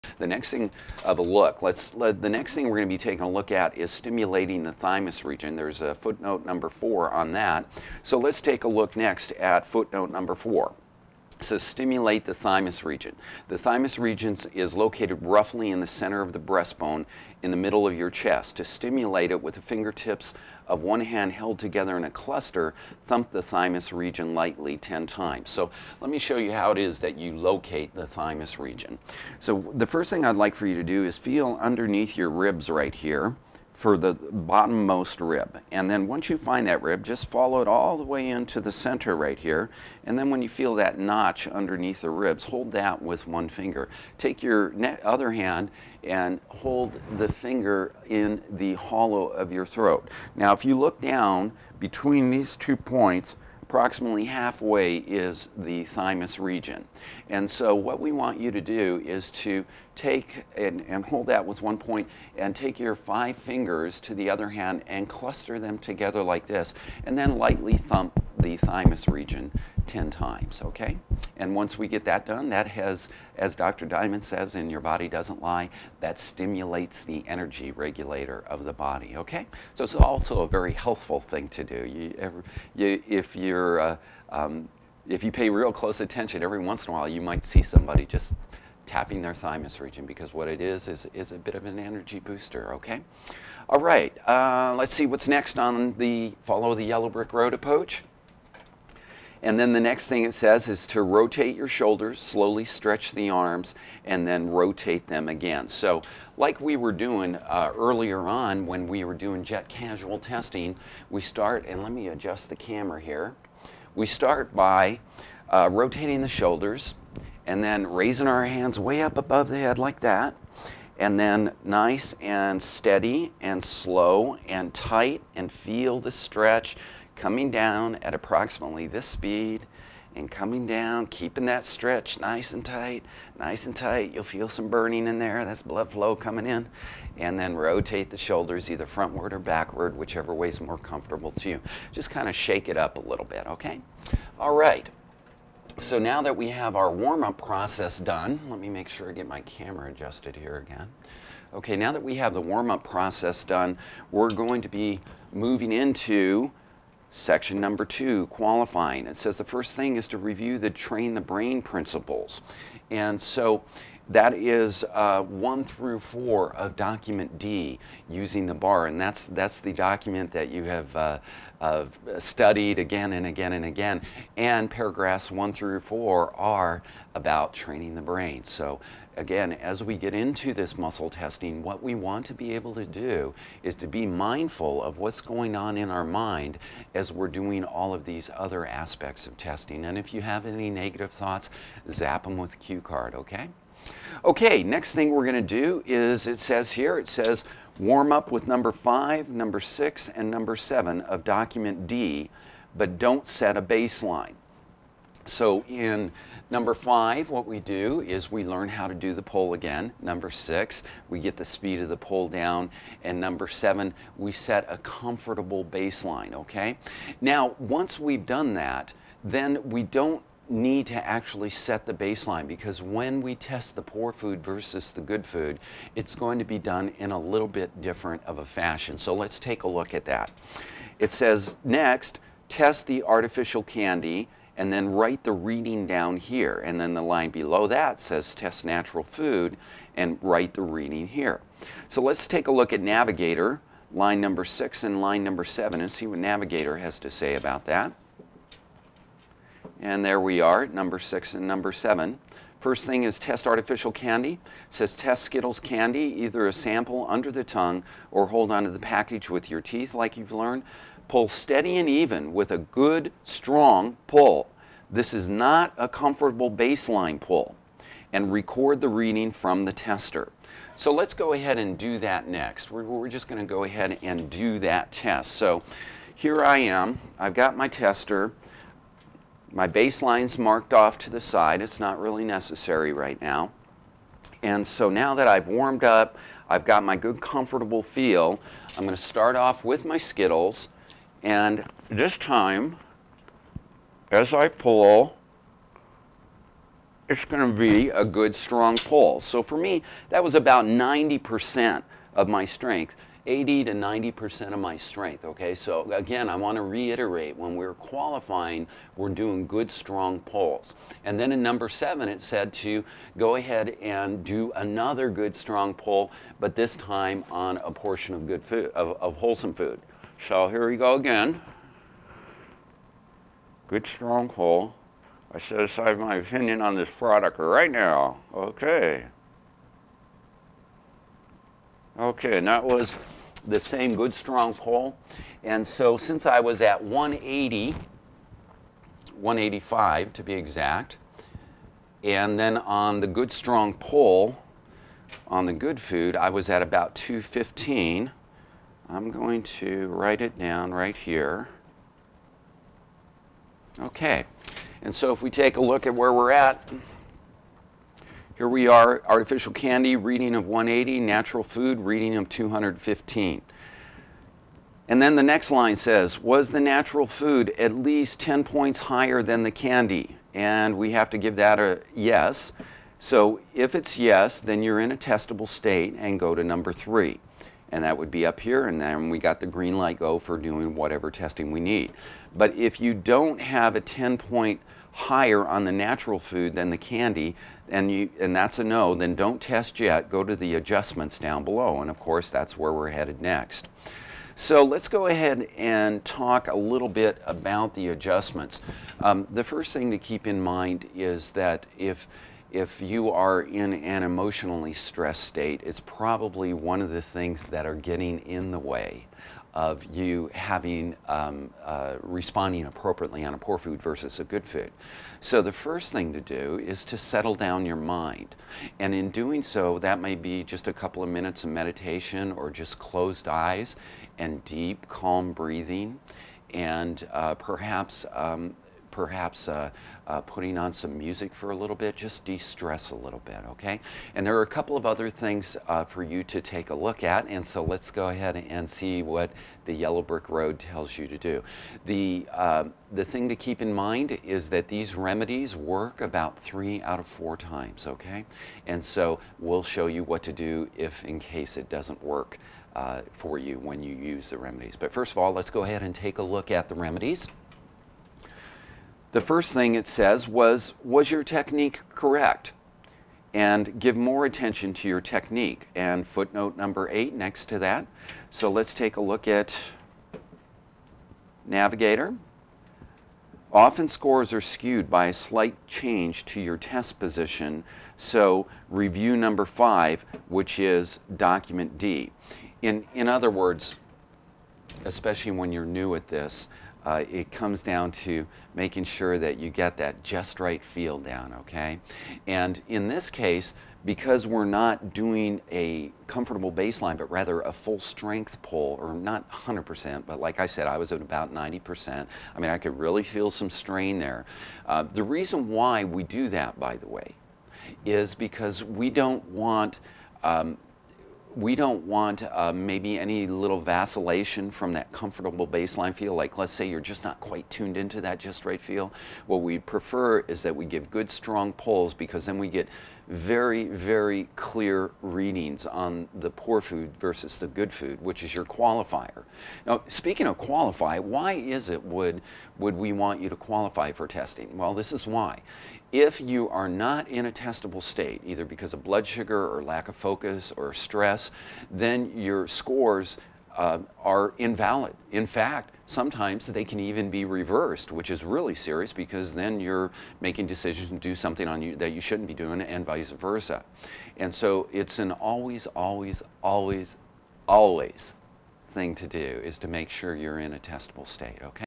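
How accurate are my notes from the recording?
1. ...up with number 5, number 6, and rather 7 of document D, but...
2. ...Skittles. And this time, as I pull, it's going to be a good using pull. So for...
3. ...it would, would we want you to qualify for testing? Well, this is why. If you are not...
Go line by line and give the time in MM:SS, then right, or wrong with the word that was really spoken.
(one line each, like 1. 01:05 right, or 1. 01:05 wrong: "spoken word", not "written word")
1. 03:18 wrong: "number", not "rather"
2. 04:49 wrong: "strong", not "using"
3. 08:51 right.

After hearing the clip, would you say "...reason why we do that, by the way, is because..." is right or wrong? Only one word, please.
right.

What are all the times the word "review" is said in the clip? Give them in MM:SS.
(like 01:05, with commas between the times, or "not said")
02:40, 07:58.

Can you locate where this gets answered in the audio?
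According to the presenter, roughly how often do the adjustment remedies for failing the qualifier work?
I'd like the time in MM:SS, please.
07:26.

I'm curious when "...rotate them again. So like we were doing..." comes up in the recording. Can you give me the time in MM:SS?
01:44.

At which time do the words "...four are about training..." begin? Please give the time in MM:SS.
02:55.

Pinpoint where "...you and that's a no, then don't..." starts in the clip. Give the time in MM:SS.
06:27.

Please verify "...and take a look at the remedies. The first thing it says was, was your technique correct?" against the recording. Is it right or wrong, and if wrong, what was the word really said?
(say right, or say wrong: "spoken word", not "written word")
right.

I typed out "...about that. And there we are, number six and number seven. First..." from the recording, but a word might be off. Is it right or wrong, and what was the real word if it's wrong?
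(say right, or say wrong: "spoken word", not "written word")
right.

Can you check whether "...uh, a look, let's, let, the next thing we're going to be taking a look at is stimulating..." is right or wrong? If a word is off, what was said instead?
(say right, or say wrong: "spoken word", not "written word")
right.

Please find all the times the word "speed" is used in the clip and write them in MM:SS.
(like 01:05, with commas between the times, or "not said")
02:09, 03:31.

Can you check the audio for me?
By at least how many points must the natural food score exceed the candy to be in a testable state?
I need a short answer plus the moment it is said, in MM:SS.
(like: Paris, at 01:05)
10 points, at 06:08.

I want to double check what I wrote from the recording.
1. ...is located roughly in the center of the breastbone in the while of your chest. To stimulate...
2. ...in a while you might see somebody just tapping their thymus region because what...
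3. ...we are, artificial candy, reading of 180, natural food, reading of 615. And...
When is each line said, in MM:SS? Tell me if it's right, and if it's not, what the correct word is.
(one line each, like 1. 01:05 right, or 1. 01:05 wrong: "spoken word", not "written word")
1. 00:14 wrong: "middle", not "while"
2. 01:26 right
3. 05:58 wrong: "215", not "615".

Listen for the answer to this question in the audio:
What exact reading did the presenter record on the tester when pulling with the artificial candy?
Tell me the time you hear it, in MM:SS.
05:39.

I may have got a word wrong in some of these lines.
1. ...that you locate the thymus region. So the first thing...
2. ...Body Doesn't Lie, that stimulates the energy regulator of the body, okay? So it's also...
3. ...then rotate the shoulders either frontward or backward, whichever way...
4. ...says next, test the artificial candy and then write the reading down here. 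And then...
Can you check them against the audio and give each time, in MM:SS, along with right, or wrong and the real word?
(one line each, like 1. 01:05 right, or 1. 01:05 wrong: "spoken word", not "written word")
1. 00:26 right
2. 01:14 right
3. 02:17 right
4. 03:51 right.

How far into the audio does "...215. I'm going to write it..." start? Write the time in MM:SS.
05:46.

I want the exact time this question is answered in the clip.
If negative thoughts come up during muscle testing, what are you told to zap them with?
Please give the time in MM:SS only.
03:12.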